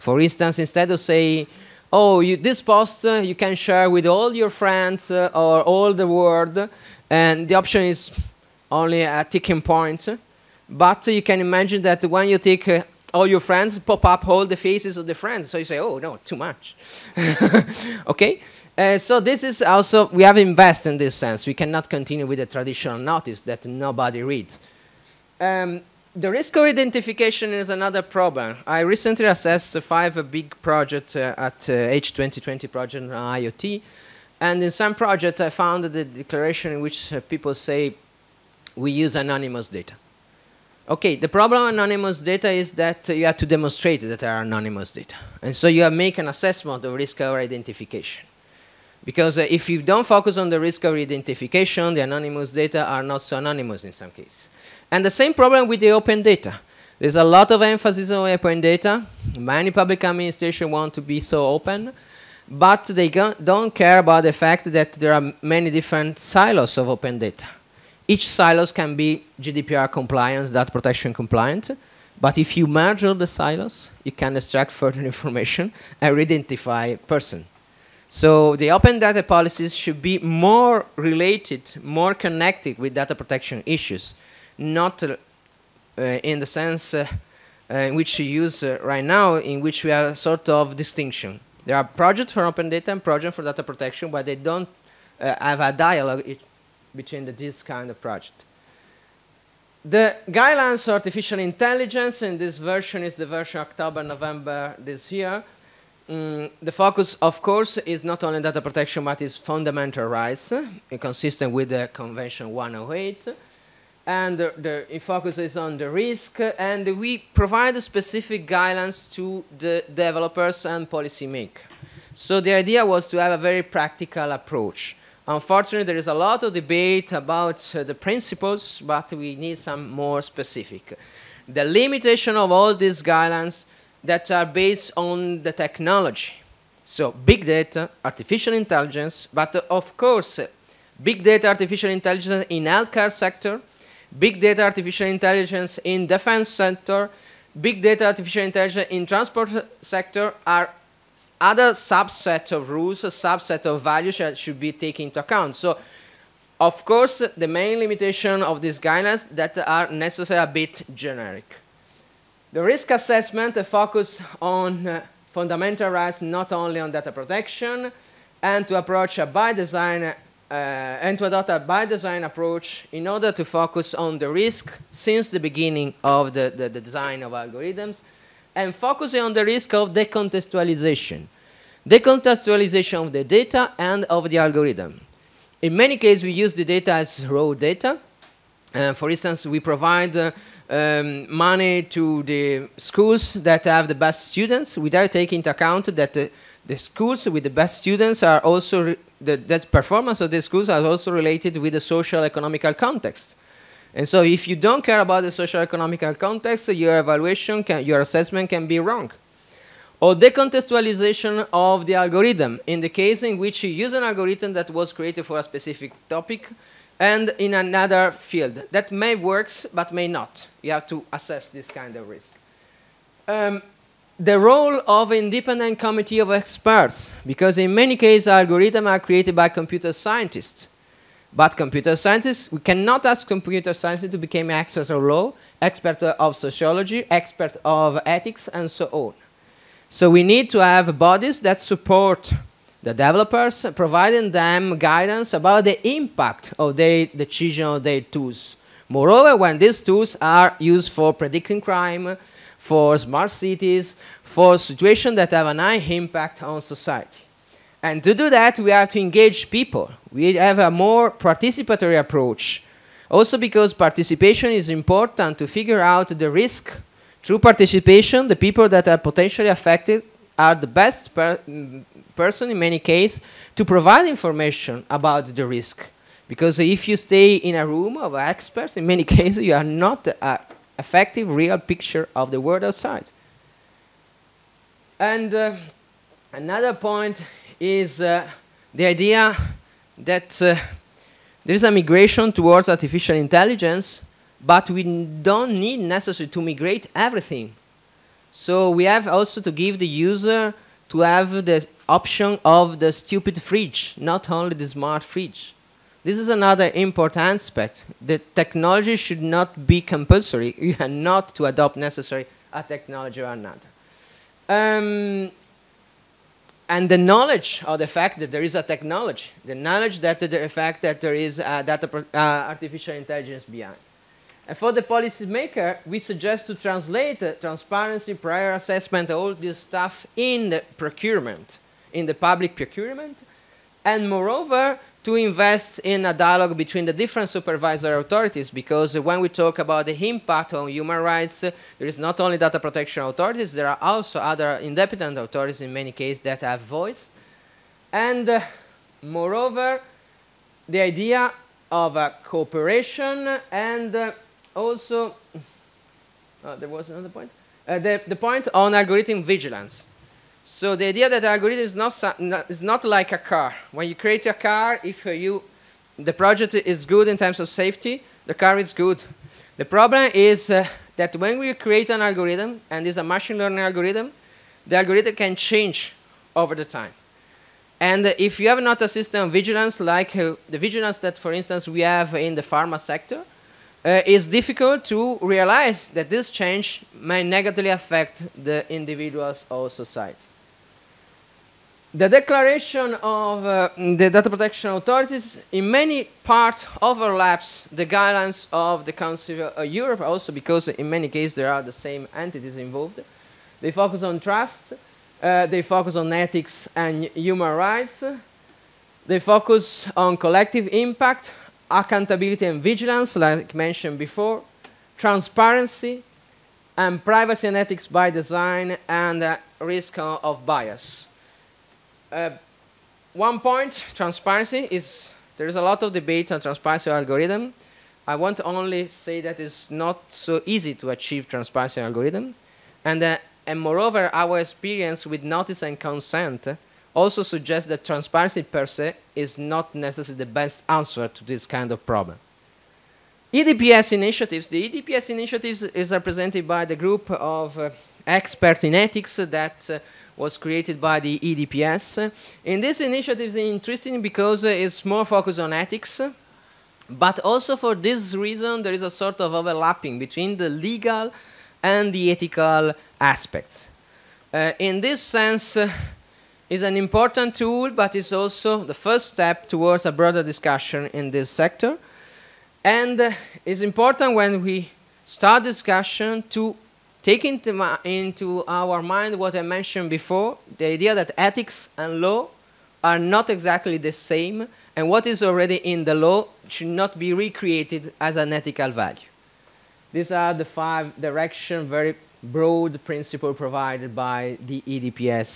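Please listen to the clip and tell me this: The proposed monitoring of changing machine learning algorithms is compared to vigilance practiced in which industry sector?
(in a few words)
Pharma sector.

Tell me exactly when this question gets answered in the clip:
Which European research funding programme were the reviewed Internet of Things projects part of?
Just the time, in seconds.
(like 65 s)
31 s.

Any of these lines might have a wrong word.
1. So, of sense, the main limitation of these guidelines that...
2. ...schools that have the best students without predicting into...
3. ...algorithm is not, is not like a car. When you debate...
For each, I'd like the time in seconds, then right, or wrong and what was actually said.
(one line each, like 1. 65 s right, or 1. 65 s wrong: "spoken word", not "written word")
1. 155 s wrong: "course", not "sense"
2. 192 s wrong: "taking", not "predicting"
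3. 361 s wrong: "create", not "debate".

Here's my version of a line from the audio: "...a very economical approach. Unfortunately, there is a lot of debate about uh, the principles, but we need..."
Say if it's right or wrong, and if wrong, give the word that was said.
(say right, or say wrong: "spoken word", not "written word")
wrong: "practical", not "economical".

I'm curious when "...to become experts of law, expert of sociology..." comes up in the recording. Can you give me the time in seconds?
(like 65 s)
234 s.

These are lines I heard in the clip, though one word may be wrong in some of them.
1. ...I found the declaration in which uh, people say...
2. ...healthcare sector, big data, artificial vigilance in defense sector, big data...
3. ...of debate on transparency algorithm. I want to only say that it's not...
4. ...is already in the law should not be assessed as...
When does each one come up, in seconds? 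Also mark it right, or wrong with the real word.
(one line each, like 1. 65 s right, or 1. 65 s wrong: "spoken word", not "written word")
1. 35 s right
2. 142 s wrong: "intelligence", not "vigilance"
3. 425 s right
4. 485 s wrong: "recreated", not "assessed".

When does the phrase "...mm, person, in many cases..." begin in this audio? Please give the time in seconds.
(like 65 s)
271 s.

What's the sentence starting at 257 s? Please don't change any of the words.
And to do that, we have to engage people.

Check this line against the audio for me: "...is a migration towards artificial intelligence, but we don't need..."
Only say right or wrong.
right.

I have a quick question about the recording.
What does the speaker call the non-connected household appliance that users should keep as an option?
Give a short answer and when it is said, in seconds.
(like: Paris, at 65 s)
The stupid fridge, at 302 s.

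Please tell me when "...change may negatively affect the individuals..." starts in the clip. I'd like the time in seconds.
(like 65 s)
386 s.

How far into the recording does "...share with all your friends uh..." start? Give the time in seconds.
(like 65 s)
3 s.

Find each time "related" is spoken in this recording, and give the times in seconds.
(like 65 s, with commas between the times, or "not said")
80 s, 201 s.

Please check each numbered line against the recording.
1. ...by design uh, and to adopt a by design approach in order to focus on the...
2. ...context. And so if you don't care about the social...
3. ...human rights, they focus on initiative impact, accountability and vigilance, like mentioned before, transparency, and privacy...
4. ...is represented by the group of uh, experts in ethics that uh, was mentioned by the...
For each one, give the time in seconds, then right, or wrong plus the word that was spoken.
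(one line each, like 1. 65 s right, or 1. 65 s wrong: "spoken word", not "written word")
1. 169 s right
2. 202 s right
3. 407 s wrong: "collective", not "initiative"
4. 445 s wrong: "created", not "mentioned".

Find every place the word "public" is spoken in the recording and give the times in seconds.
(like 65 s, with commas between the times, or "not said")
59 s, 332 s.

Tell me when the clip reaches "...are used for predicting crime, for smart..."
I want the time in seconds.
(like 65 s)
250 s.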